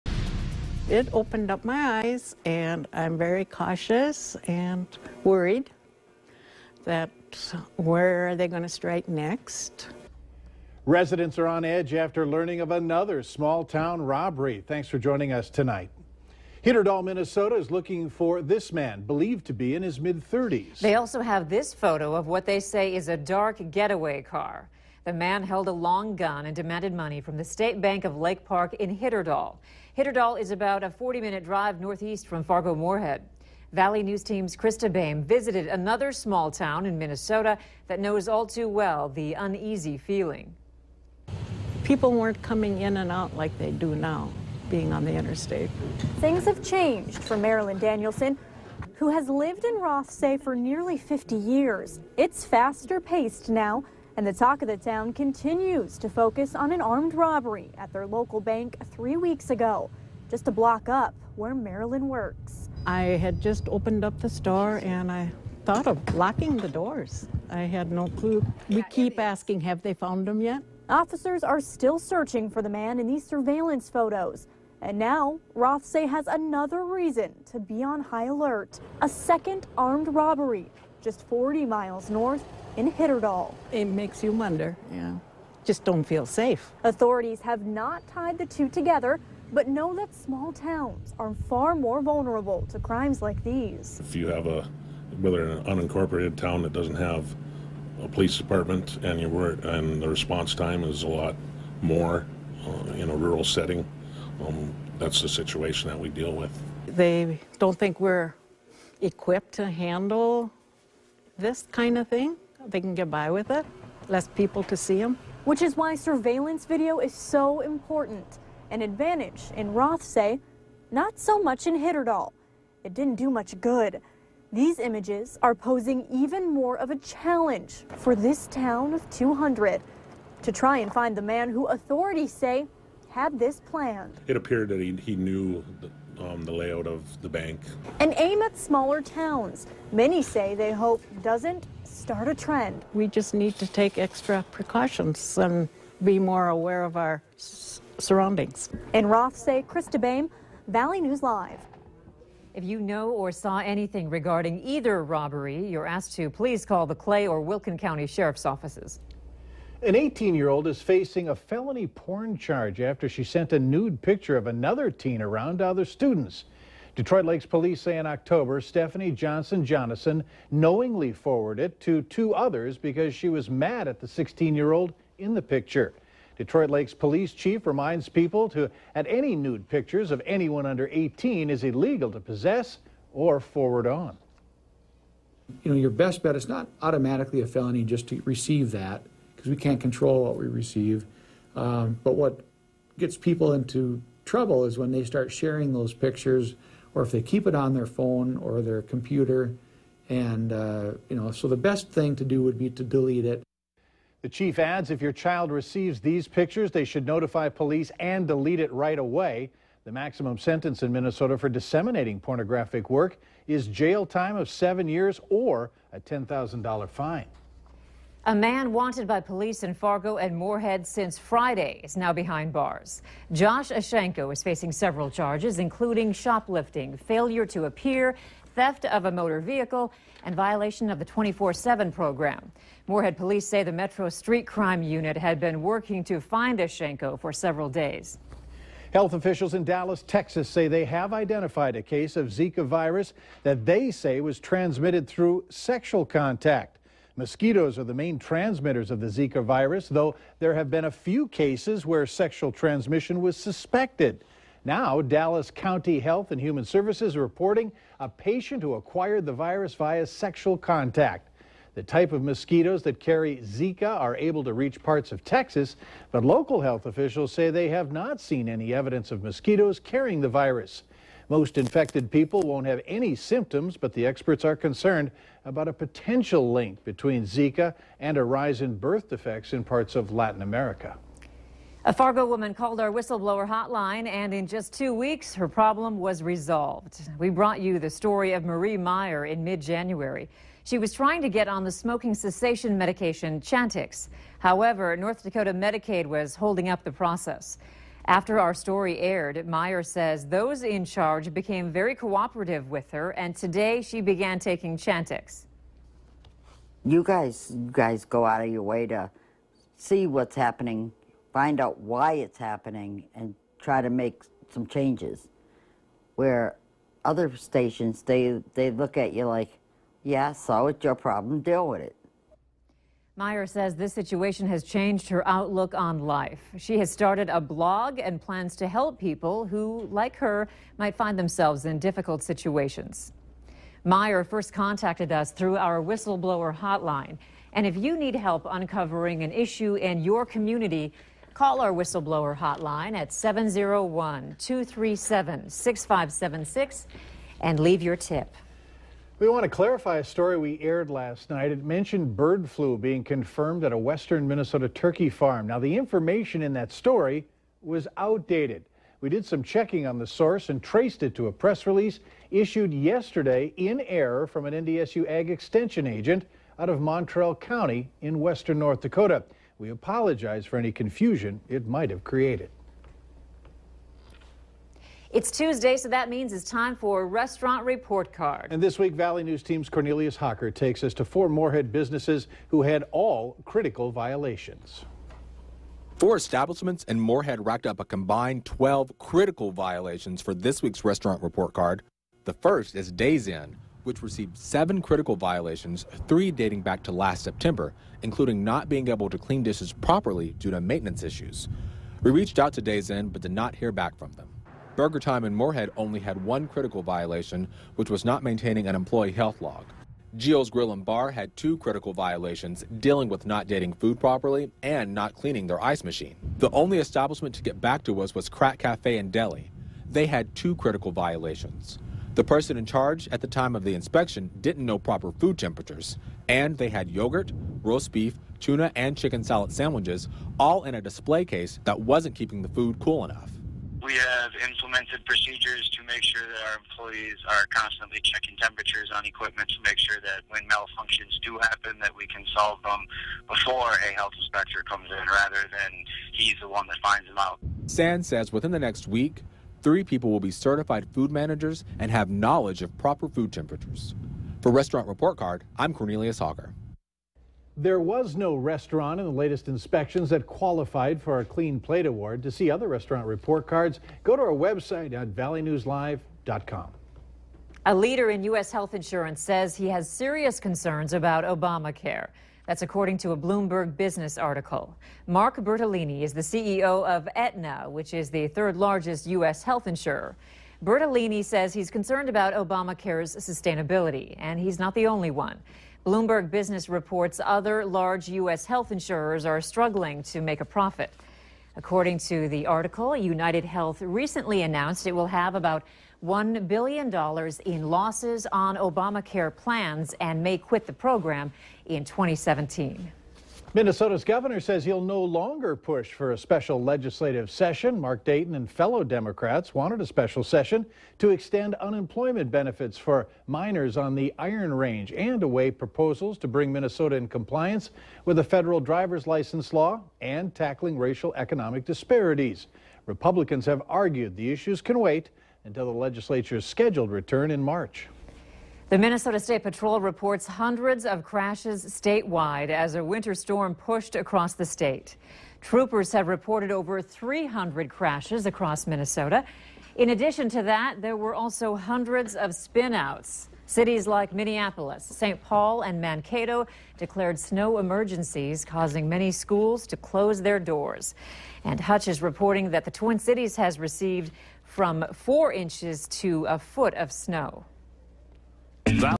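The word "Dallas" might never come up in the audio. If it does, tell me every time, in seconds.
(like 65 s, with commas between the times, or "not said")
239 s, 255 s.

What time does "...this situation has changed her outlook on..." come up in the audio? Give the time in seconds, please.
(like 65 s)
323 s.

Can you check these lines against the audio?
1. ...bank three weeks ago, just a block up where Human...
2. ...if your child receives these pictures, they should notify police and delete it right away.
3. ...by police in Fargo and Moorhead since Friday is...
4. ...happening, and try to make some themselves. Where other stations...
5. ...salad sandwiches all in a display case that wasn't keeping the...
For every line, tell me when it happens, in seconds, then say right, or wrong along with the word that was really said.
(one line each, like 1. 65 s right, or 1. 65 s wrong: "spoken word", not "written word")
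1. 58 s wrong: "Marilyn", not "Human"
2. 204 s right
3. 219 s right
4. 312 s wrong: "changes", not "themselves"
5. 429 s right.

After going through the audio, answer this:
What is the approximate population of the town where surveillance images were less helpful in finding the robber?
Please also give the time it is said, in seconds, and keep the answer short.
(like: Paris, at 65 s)
200, at 129 s.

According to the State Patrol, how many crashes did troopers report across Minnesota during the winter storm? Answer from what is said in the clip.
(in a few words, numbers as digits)
over 300.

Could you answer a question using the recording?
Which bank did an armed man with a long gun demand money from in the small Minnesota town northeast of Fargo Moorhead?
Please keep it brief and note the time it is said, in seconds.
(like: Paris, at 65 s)
State Bank of Lake Park, at 27 s.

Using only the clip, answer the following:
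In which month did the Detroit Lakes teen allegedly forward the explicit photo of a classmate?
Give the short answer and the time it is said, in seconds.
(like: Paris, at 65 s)
October, at 168 s.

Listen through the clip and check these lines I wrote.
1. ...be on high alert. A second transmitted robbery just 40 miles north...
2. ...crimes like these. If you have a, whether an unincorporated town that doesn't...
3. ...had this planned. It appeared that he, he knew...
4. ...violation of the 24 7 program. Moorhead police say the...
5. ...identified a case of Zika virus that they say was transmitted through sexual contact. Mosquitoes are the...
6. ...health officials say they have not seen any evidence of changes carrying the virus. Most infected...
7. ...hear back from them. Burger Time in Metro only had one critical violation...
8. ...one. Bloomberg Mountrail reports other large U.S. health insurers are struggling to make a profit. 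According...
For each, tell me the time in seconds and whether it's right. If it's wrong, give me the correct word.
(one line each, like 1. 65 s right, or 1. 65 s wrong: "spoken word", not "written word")
1. 77 s wrong: "armed", not "transmitted"
2. 92 s right
3. 133 s right
4. 230 s right
5. 241 s right
6. 266 s wrong: "mosquitoes", not "changes"
7. 403 s wrong: "Moorhead", not "Metro"
8. 485 s wrong: "Business", not "Mountrail".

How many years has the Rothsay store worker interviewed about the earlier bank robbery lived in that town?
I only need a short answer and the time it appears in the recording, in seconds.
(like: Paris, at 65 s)
nearly 50 years, at 50 s.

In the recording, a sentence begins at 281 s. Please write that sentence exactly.
A Fargo woman called our whistleblower hotline, and in just two weeks, her problem was resolved.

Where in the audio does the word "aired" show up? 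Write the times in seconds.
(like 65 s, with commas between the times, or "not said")
298 s, 350 s.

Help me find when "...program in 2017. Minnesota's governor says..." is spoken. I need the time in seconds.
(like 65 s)
500 s.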